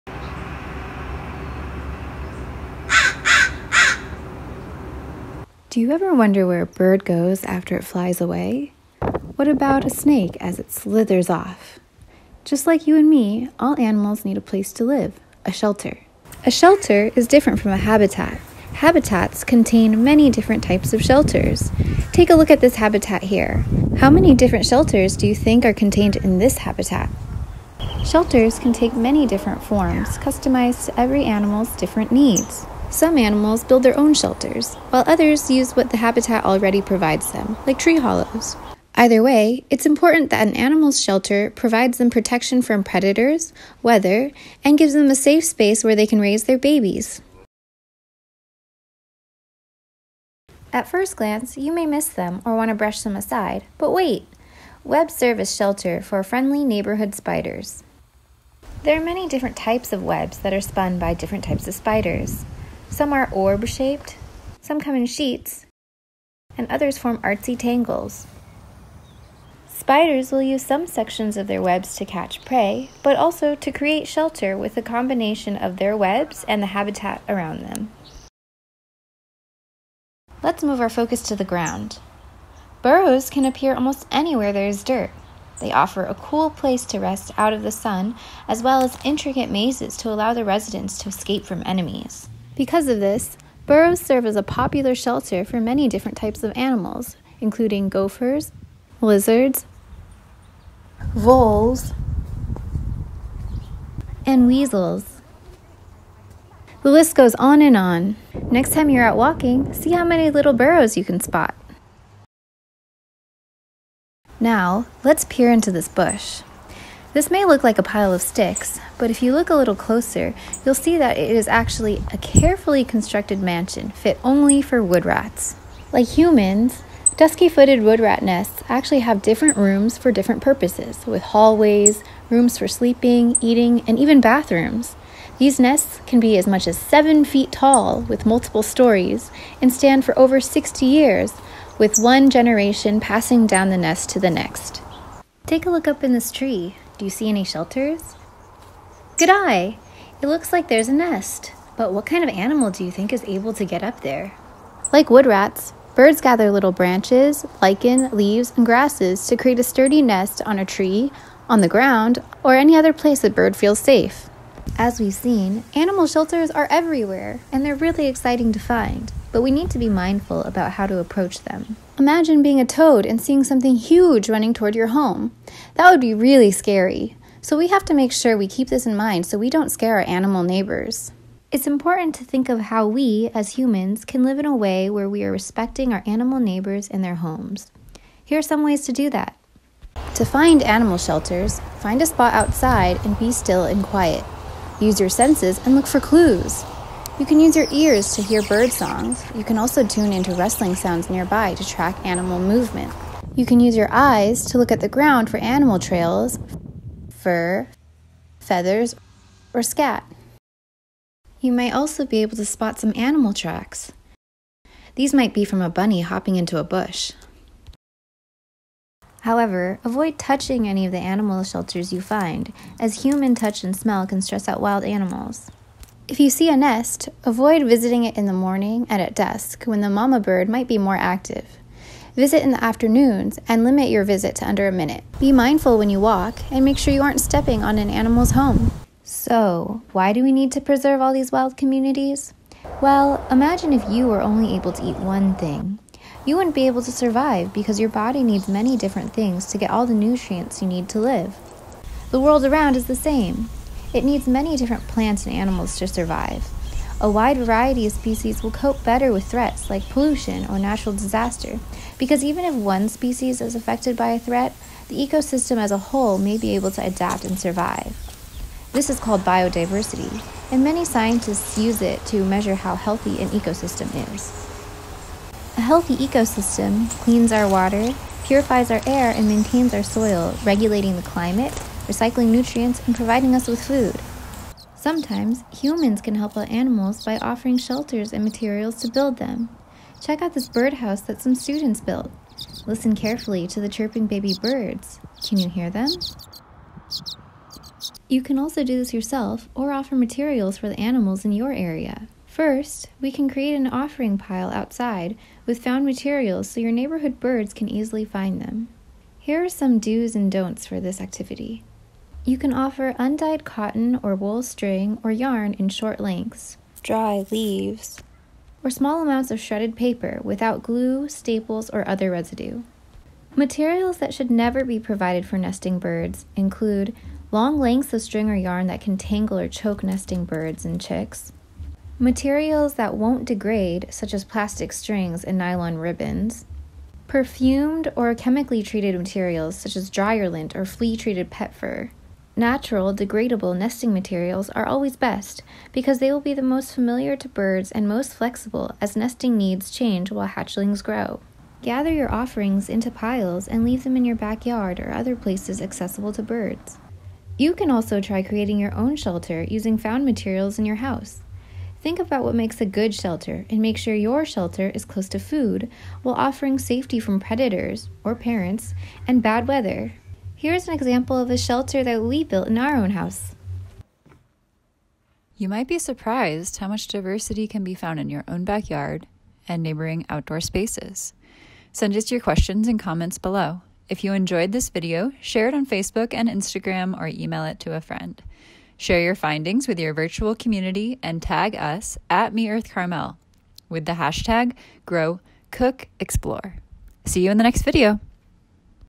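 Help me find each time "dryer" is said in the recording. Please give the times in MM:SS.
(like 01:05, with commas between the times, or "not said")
05:39.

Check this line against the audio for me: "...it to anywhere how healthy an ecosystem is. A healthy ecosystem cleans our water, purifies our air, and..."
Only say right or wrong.
wrong.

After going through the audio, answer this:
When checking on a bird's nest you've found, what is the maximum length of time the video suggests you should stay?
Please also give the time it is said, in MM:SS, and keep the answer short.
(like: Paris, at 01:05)
under a minute, at 03:54.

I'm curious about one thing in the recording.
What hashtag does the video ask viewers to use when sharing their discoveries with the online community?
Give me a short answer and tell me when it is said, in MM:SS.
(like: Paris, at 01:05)
#GrowCookExplore, at 06:34.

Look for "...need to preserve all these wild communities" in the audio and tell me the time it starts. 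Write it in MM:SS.
04:00.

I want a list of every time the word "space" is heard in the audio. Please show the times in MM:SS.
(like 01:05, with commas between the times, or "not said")
00:45, 06:20.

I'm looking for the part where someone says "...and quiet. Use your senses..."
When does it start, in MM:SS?
03:13.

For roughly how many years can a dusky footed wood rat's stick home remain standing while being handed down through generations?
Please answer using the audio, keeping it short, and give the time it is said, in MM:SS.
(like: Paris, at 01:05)
over 60 years, at 02:20.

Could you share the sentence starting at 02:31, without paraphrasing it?
But what kind of animal do you think is able to get up there?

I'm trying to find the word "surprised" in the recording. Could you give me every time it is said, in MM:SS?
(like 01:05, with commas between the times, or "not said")
06:15.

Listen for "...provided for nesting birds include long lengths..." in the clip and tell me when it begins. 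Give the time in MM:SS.
05:24.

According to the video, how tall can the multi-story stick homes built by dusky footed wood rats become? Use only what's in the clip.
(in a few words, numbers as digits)
7 feet.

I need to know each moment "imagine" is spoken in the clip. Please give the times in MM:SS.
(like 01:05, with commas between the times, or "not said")
02:51, 04:03.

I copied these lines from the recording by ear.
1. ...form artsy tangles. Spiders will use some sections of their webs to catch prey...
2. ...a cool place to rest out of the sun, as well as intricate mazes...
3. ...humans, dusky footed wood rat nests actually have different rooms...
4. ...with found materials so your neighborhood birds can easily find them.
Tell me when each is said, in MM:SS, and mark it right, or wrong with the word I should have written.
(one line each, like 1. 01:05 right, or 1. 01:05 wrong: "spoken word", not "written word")
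1. 01:06 right
2. 01:26 right
3. 02:06 right
4. 05:05 right.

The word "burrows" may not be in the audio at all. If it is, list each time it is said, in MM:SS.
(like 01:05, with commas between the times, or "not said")
01:22, 01:33, 01:50.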